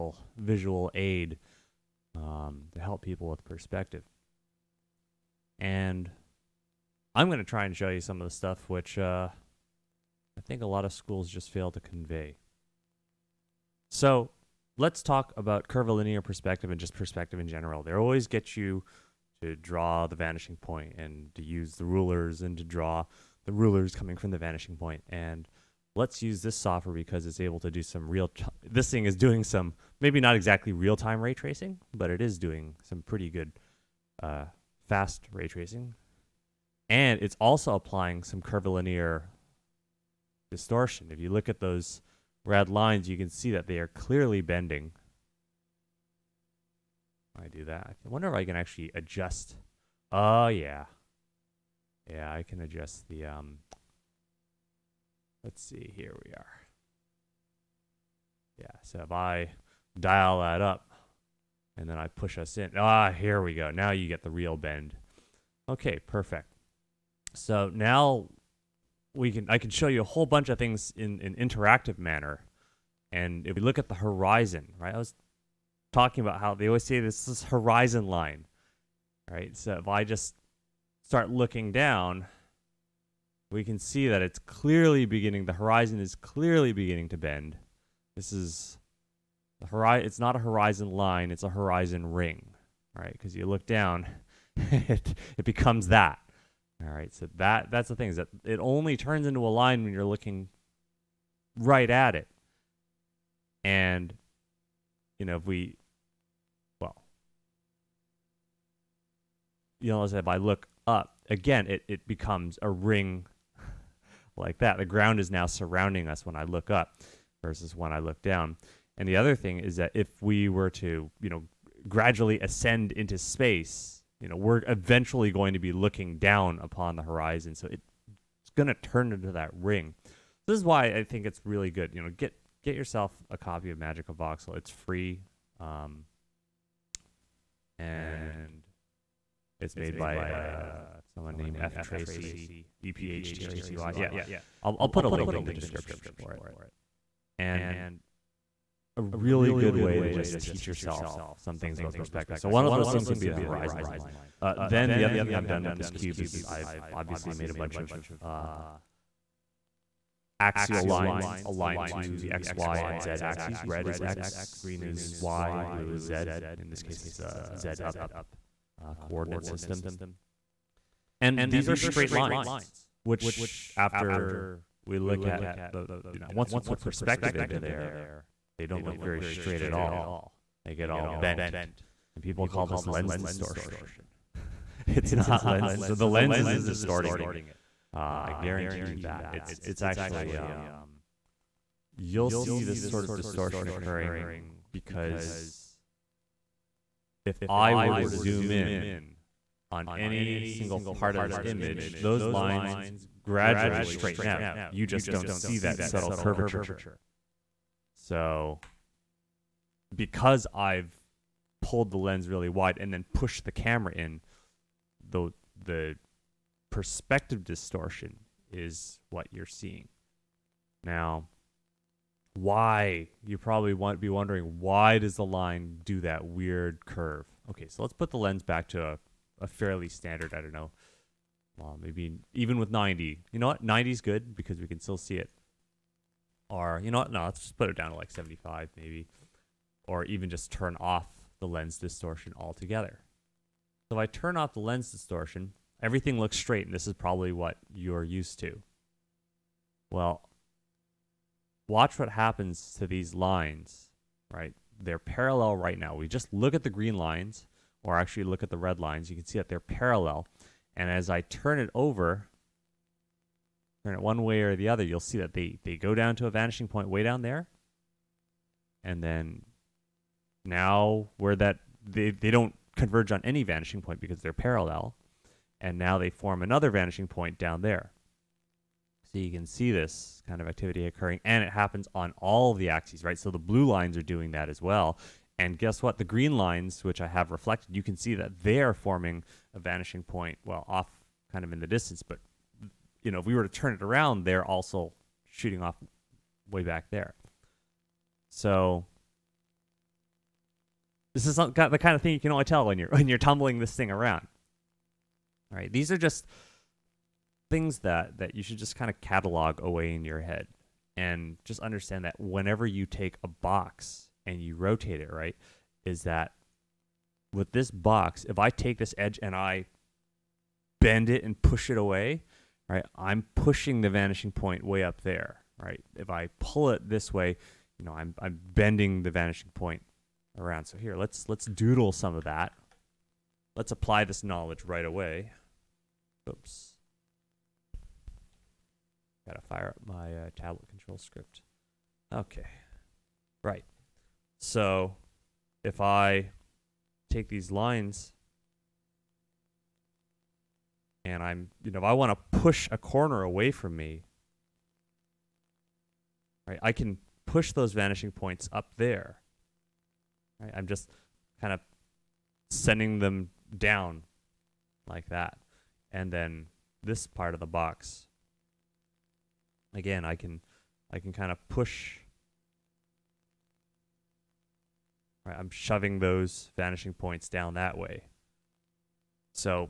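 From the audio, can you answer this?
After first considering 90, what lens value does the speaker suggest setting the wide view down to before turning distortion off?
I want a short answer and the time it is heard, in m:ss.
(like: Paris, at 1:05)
75, at 3:58.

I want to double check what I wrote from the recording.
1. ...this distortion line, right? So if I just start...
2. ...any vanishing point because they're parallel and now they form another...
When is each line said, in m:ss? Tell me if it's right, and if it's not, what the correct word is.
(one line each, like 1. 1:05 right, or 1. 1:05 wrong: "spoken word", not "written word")
1. 1:17 wrong: "horizon", not "distortion"
2. 4:33 right.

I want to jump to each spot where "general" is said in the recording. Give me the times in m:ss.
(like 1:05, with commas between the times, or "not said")
0:17.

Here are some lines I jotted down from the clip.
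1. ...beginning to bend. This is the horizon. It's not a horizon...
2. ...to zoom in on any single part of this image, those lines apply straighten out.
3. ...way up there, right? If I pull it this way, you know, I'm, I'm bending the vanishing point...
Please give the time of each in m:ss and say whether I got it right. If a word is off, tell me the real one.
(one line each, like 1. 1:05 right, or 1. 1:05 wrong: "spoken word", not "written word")
1. 1:26 right
2. 3:17 wrong: "gradually", not "apply"
3. 5:24 right.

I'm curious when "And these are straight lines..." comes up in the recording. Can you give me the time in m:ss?
2:51.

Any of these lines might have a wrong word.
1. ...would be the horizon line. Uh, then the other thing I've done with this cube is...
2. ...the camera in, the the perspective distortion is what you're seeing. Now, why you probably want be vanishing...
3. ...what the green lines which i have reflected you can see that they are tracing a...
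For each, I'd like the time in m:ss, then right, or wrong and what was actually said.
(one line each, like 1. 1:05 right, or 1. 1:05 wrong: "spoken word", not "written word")
1. 2:33 right
2. 3:33 wrong: "wondering", not "vanishing"
3. 4:45 wrong: "forming", not "tracing".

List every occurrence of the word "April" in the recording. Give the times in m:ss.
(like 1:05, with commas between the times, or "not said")
not said.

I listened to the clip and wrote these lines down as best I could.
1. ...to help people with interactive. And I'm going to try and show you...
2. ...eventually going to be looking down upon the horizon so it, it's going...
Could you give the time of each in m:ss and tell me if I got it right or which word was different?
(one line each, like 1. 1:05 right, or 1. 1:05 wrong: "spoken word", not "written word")
1. 0:02 wrong: "perspective", not "interactive"
2. 2:04 right.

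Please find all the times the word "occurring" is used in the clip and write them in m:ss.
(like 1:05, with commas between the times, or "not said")
3:13, 4:40.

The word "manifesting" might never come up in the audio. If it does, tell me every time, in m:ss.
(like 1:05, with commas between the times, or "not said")
not said.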